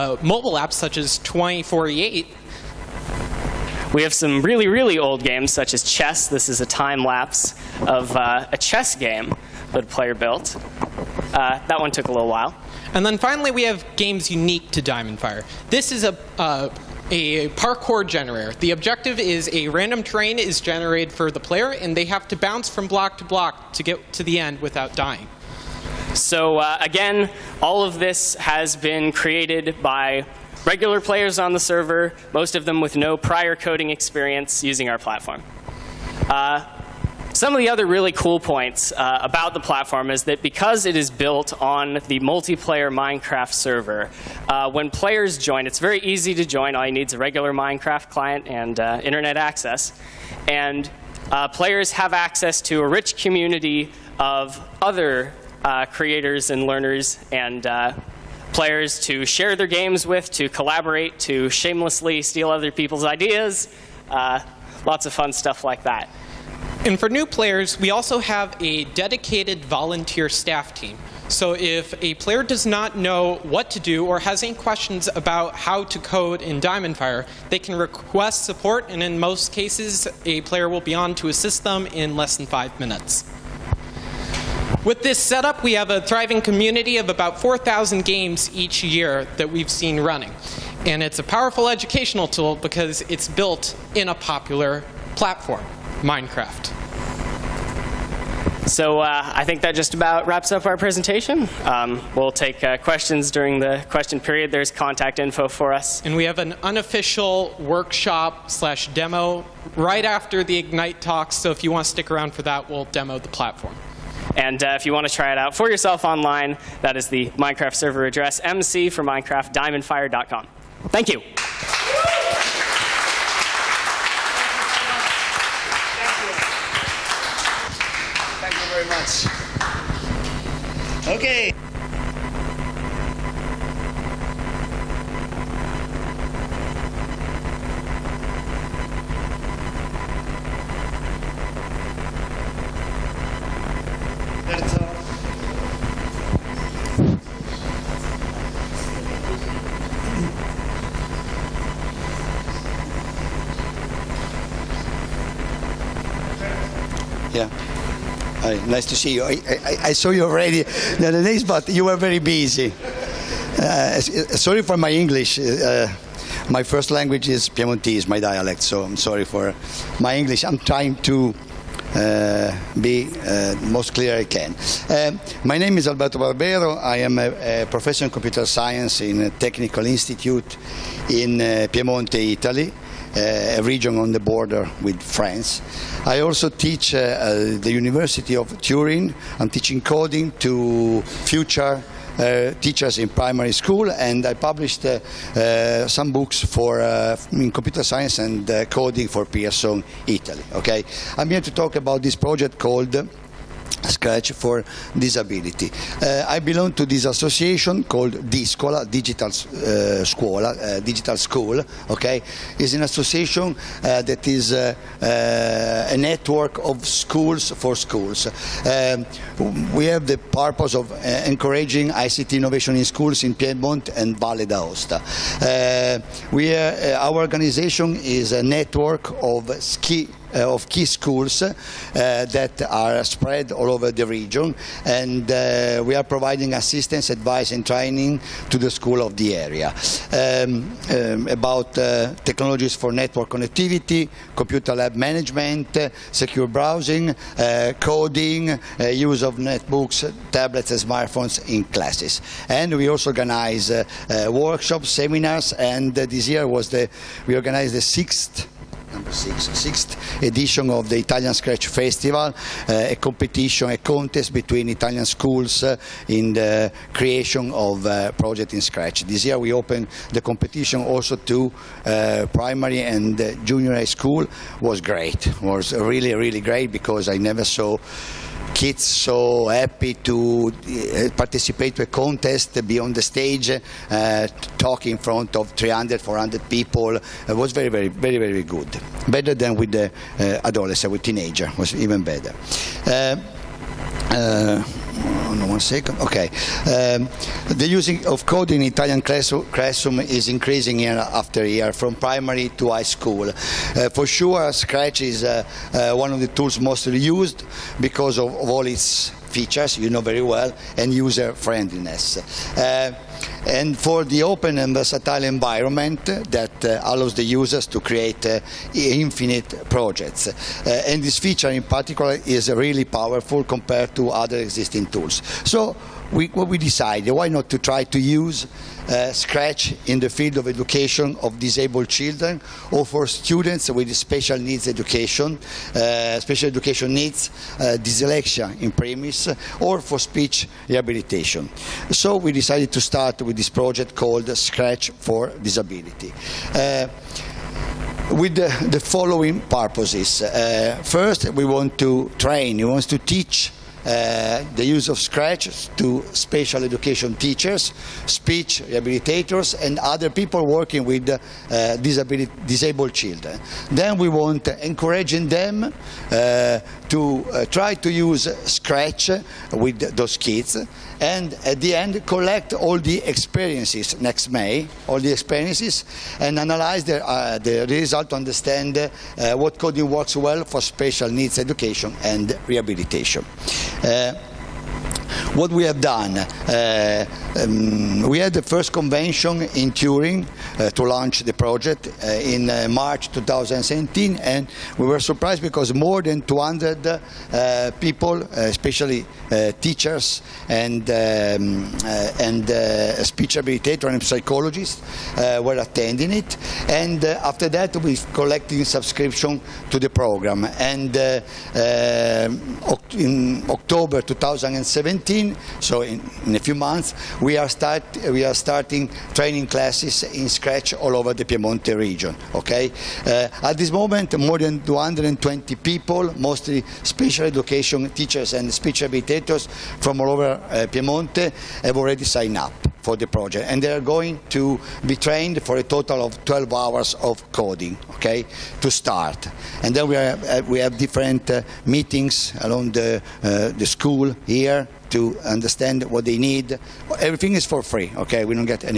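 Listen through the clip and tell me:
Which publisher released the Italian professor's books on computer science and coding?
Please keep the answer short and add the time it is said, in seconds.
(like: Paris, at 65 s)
Pearson Italy, at 199 s.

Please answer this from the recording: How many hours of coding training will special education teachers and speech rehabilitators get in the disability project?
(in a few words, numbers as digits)
12.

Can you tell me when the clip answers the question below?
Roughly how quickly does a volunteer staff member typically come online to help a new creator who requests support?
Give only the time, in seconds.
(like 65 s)
82 s.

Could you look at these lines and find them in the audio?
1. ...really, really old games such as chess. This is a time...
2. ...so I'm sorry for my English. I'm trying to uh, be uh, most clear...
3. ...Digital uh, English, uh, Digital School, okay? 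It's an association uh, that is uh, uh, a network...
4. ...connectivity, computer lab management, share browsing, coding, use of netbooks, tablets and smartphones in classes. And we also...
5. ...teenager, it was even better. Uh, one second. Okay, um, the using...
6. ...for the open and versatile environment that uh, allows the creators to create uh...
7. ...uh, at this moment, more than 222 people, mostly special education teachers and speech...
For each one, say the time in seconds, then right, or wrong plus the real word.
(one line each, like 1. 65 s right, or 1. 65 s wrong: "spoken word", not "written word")
1. 4 s right
2. 168 s right
3. 208 s wrong: "Scuola", not "English"
4. 243 s wrong: "secure", not "share"
5. 291 s right
6. 313 s wrong: "users", not "creators"
7. 423 s wrong: "220", not "222".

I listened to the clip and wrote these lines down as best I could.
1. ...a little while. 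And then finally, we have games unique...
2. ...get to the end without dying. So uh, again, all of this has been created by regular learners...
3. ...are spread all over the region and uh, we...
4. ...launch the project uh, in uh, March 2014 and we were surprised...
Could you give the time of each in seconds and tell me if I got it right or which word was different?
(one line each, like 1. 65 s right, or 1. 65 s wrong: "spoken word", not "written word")
1. 12 s right
2. 23 s wrong: "players", not "learners"
3. 232 s right
4. 390 s wrong: "2017", not "2014".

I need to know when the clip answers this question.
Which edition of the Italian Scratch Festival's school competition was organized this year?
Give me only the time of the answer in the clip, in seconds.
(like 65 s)
259 s.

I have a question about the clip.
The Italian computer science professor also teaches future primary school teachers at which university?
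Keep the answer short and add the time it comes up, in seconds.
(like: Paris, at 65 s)
University of Turin, at 187 s.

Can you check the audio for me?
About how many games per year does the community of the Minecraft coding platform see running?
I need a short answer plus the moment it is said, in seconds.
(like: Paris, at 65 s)
4,000, at 87 s.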